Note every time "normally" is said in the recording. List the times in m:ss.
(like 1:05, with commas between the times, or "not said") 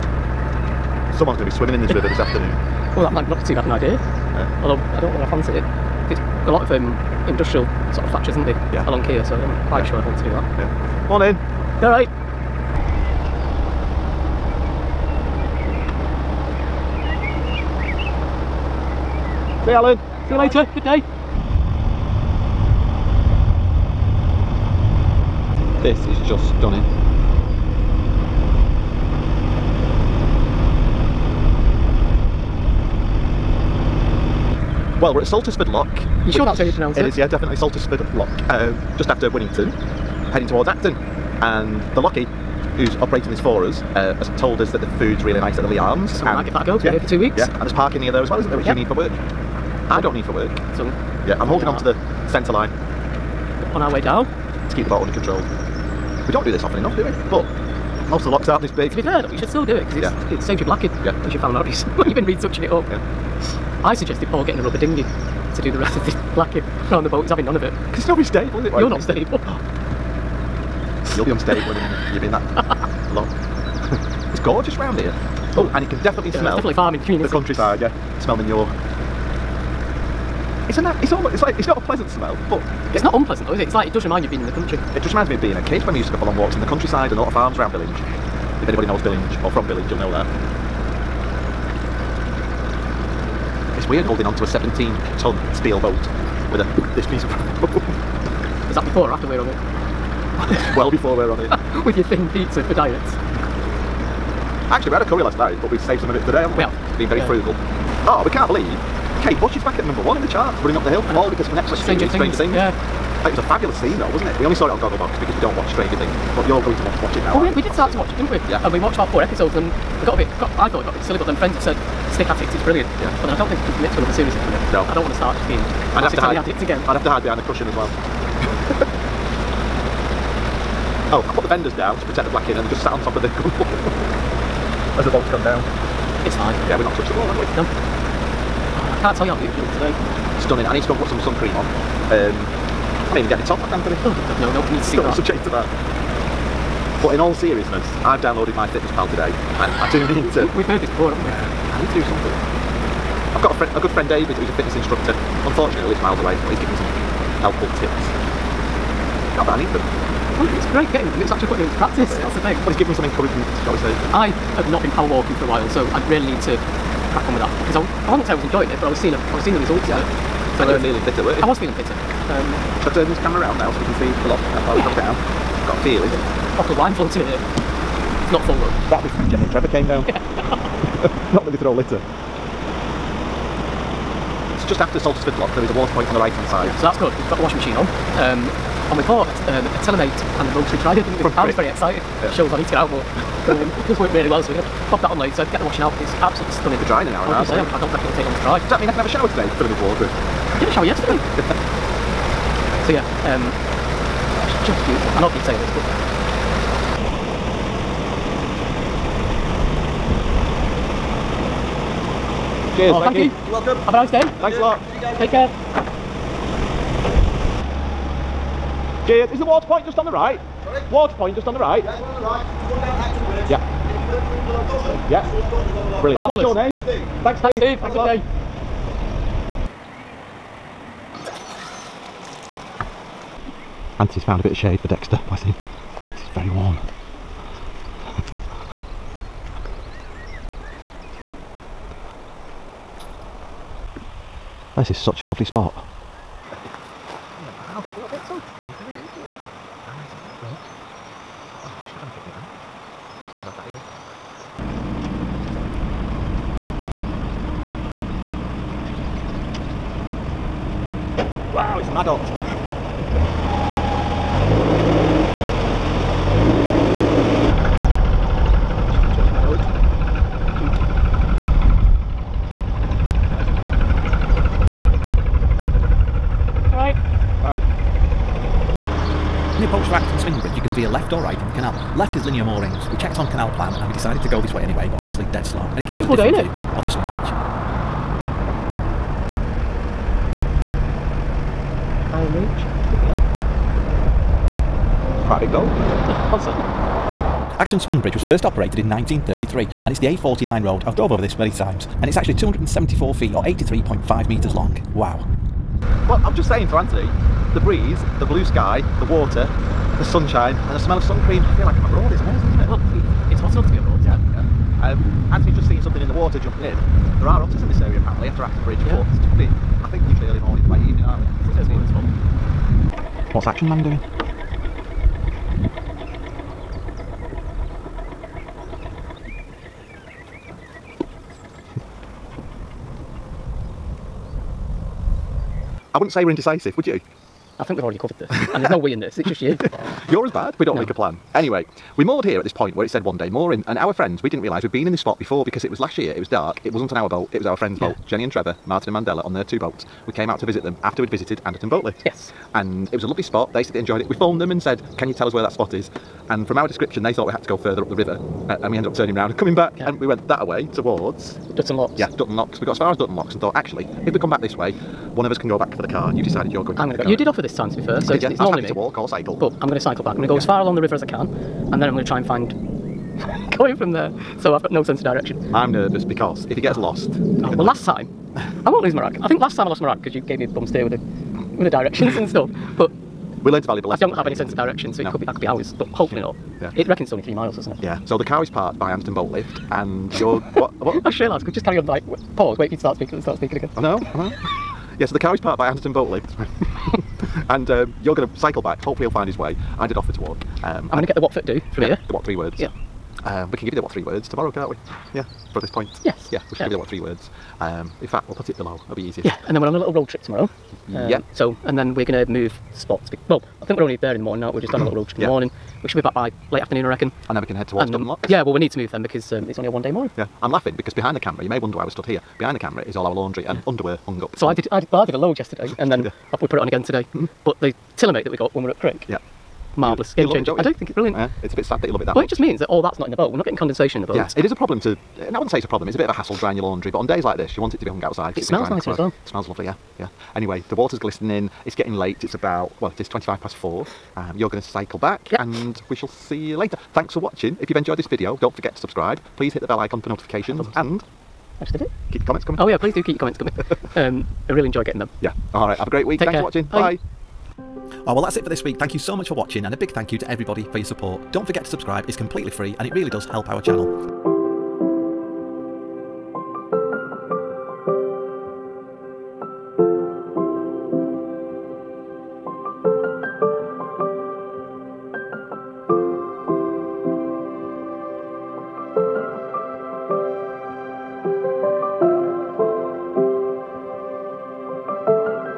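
6:08.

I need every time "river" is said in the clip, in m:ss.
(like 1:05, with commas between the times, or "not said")
0:01, 5:57, 6:10.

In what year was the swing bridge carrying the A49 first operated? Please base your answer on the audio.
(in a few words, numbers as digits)
1933.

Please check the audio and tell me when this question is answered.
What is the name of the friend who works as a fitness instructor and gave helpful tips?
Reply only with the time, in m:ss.
2:34.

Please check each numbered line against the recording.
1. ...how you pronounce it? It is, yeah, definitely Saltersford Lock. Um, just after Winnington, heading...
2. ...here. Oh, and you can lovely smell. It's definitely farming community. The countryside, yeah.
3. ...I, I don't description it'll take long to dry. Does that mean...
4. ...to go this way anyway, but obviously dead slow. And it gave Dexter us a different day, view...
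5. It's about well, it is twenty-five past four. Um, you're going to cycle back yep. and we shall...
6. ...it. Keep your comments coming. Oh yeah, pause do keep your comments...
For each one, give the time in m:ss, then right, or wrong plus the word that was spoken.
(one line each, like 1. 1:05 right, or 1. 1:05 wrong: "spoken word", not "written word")
1. 0:36 right
2. 1:14 wrong: "definitely", not "lovely"
3. 3:17 wrong: "reckon", not "description"
4. 4:44 wrong: "Beautiful", not "Dexter"
5. 7:22 right
6. 7:31 wrong: "please", not "pause".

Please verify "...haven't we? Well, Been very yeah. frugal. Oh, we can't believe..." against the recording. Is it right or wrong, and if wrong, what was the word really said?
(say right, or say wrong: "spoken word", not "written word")
right.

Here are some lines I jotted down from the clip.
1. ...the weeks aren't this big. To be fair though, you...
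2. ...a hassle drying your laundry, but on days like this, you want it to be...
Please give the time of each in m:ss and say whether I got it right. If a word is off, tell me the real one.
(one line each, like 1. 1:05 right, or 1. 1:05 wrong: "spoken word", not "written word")
1. 0:58 wrong: "locks", not "weeks"
2. 7:16 right.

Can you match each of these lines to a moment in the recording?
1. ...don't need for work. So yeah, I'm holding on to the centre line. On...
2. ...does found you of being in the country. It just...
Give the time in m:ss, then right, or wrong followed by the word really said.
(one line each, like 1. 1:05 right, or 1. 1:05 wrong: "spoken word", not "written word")
1. 0:49 right
2. 1:23 wrong: "remind", not "found".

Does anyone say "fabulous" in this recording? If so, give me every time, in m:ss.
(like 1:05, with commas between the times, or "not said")
1:53.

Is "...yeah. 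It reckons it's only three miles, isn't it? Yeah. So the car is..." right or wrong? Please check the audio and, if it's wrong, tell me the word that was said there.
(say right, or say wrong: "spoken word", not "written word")
right.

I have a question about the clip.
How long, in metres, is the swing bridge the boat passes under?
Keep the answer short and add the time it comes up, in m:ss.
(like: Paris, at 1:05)
83.5 metres, at 5:03.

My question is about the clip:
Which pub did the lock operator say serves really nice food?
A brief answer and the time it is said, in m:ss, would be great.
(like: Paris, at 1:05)
Leigh Arms, at 0:45.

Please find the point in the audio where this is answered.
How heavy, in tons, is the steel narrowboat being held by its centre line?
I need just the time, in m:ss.
1:34.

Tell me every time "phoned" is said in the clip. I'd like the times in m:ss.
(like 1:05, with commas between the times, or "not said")
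5:54.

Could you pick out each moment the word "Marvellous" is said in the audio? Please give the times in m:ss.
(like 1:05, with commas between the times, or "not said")
7:09.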